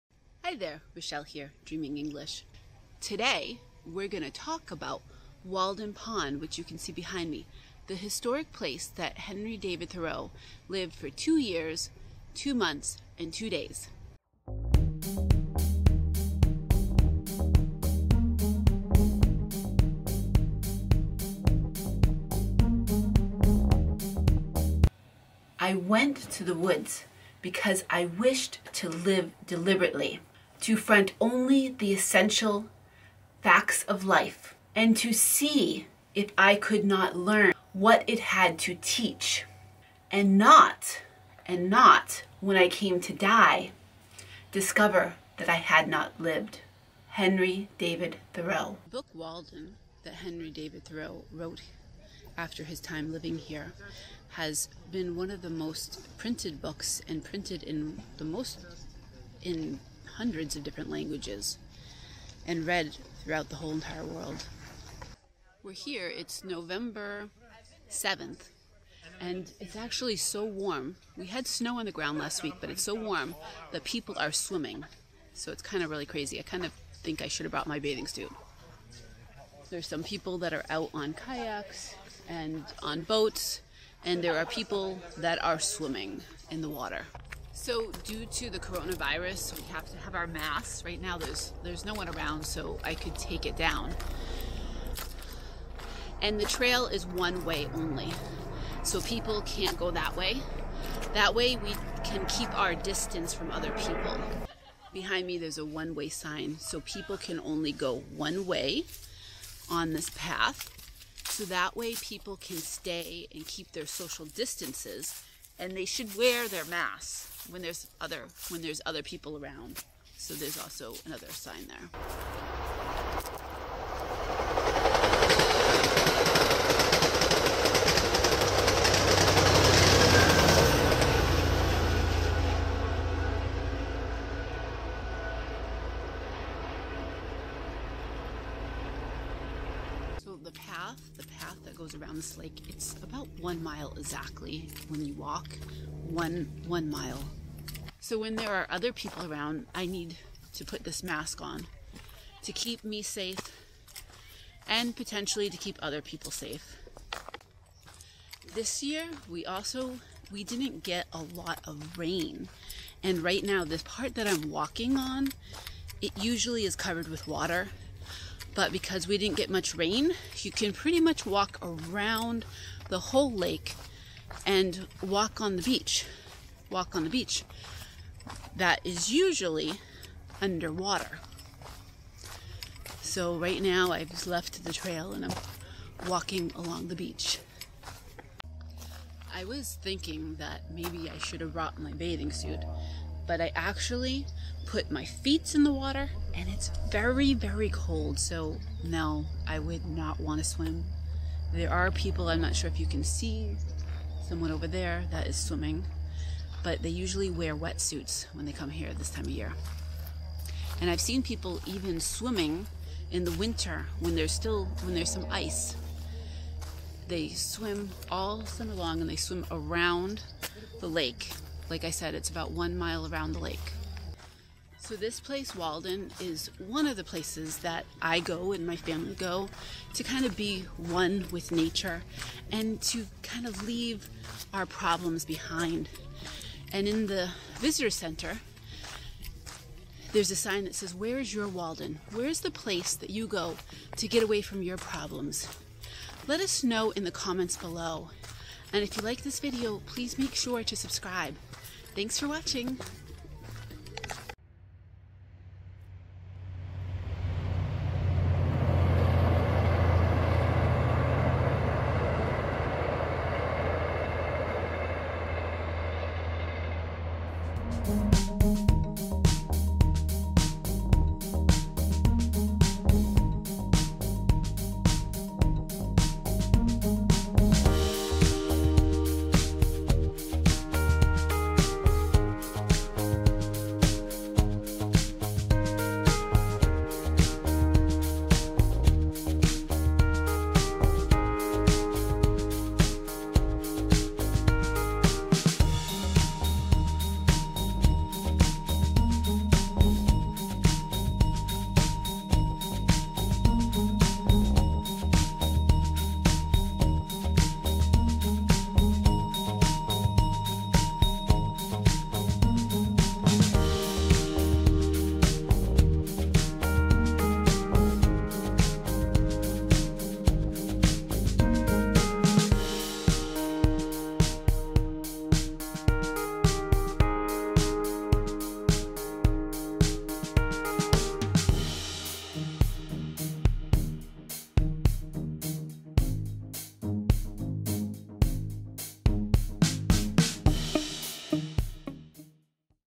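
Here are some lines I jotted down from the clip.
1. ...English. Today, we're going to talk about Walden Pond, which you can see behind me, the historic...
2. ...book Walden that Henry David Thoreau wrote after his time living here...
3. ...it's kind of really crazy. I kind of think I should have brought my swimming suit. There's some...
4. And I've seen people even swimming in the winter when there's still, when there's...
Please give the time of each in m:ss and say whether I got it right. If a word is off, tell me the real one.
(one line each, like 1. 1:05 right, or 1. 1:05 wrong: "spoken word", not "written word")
1. 0:01 right
2. 0:48 right
3. 1:15 wrong: "bathing", not "swimming"
4. 3:30 right.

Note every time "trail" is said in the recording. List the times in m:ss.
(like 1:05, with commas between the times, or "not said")
1:36, 3:04.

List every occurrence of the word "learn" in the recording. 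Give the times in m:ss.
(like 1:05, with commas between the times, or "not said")
0:37.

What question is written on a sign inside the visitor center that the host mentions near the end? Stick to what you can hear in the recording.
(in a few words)
Where is your Walden?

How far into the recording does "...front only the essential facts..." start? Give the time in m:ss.
0:30.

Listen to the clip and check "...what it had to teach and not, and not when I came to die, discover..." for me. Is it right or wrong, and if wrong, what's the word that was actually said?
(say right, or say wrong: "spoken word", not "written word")
right.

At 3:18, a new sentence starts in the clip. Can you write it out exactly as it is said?
So no, I would not want to swim.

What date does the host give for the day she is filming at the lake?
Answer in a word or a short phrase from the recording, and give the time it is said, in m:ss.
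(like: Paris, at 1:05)
November 7th, at 1:06.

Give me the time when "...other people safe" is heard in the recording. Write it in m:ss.
2:35.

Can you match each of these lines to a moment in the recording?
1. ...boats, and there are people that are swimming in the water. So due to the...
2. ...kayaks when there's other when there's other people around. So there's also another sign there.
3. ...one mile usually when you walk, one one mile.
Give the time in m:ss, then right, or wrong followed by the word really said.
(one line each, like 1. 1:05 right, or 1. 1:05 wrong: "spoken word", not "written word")
1. 1:23 right
2. 1:56 wrong: "masks", not "kayaks"
3. 2:23 wrong: "exactly", not "usually".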